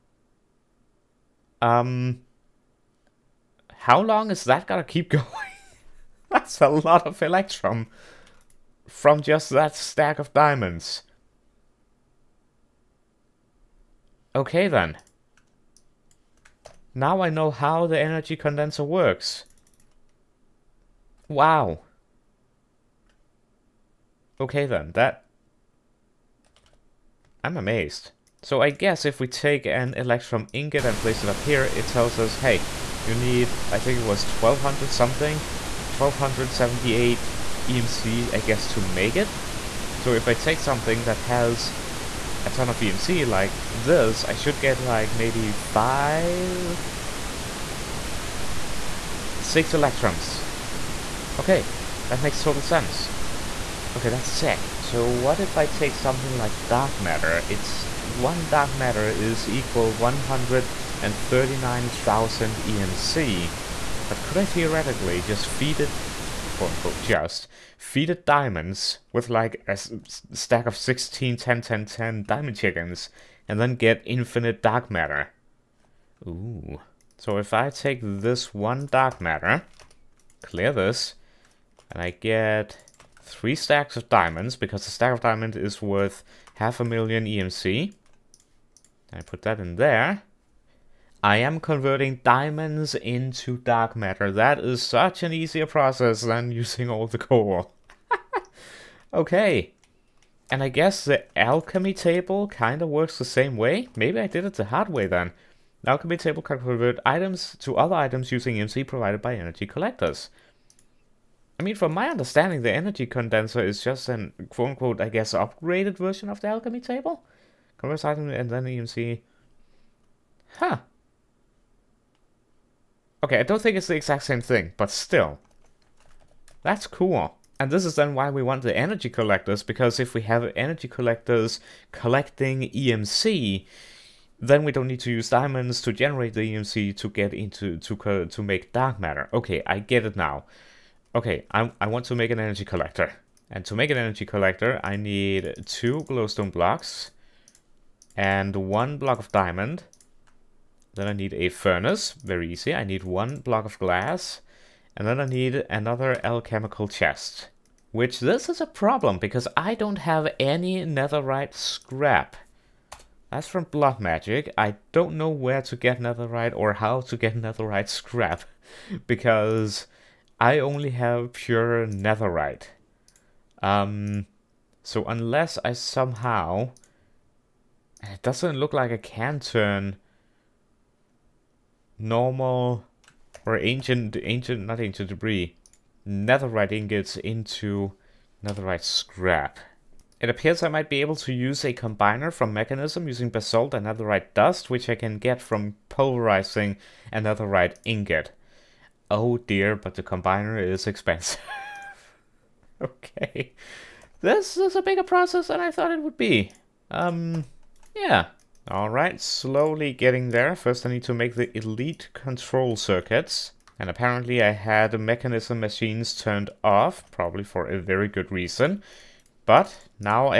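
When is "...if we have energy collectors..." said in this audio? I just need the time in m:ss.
2:09.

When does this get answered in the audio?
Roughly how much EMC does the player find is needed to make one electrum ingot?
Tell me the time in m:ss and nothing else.
0:35.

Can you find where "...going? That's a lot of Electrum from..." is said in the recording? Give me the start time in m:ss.
0:05.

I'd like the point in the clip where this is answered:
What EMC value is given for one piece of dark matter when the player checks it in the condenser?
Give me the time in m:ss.
0:59.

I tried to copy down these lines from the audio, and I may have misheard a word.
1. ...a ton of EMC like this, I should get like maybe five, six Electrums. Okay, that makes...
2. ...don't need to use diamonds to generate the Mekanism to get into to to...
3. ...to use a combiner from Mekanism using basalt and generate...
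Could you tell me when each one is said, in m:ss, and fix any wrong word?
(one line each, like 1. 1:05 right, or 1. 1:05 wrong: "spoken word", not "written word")
1. 0:42 right
2. 2:14 wrong: "EMC", not "Mekanism"
3. 3:11 wrong: "netherite", not "generate".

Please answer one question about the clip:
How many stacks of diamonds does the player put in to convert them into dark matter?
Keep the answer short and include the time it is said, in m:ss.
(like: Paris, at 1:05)
3, at 1:23.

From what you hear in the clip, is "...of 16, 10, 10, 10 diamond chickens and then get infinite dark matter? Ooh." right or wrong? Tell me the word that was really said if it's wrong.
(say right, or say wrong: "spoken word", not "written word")
right.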